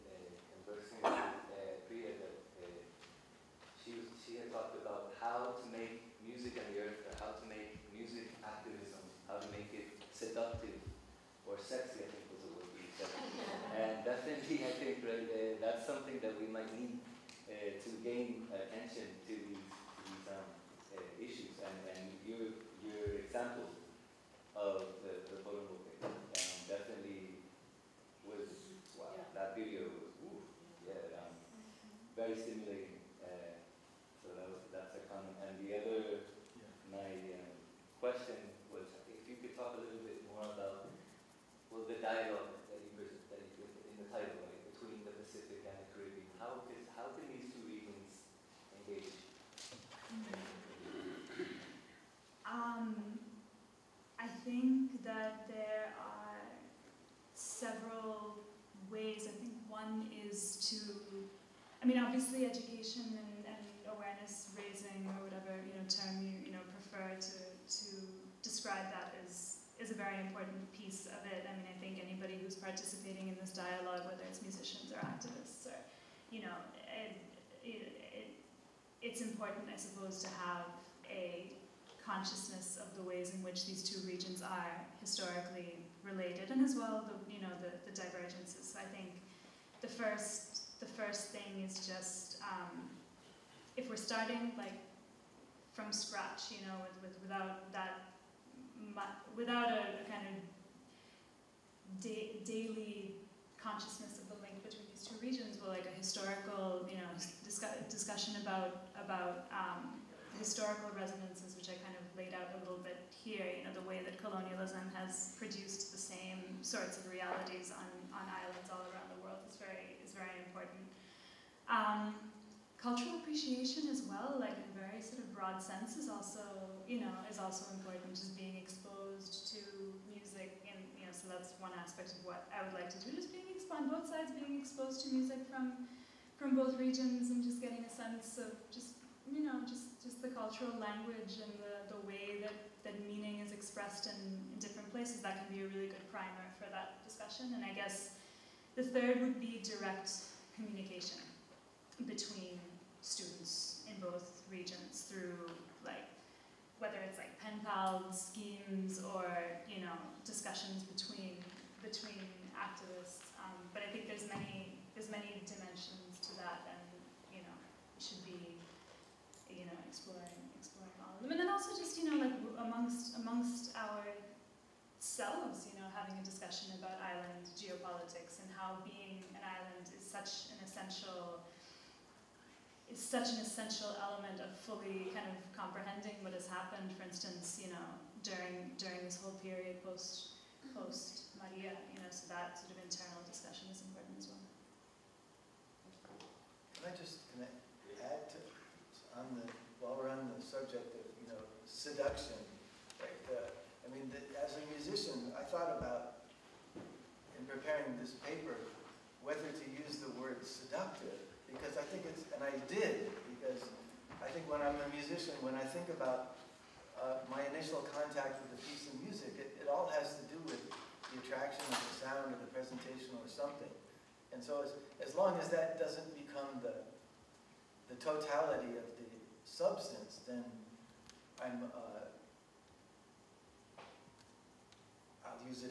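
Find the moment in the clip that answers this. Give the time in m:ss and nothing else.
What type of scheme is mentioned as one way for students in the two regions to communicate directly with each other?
2:37.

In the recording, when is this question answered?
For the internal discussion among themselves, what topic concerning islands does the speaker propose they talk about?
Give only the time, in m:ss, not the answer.
2:57.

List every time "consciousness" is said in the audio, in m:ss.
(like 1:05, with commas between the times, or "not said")
1:22, 1:43.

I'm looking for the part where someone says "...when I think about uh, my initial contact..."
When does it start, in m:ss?
3:35.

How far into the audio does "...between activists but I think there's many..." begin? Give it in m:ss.
2:41.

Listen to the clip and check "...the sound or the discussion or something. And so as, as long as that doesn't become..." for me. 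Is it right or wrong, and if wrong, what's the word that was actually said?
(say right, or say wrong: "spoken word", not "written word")
wrong: "presentation", not "discussion".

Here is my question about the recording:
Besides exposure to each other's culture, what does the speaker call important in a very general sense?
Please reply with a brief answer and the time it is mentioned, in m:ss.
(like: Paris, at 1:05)
Cultural appreciation, at 2:02.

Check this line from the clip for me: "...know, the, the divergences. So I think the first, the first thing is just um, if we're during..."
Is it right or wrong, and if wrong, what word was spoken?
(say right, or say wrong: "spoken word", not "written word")
wrong: "starting", not "during".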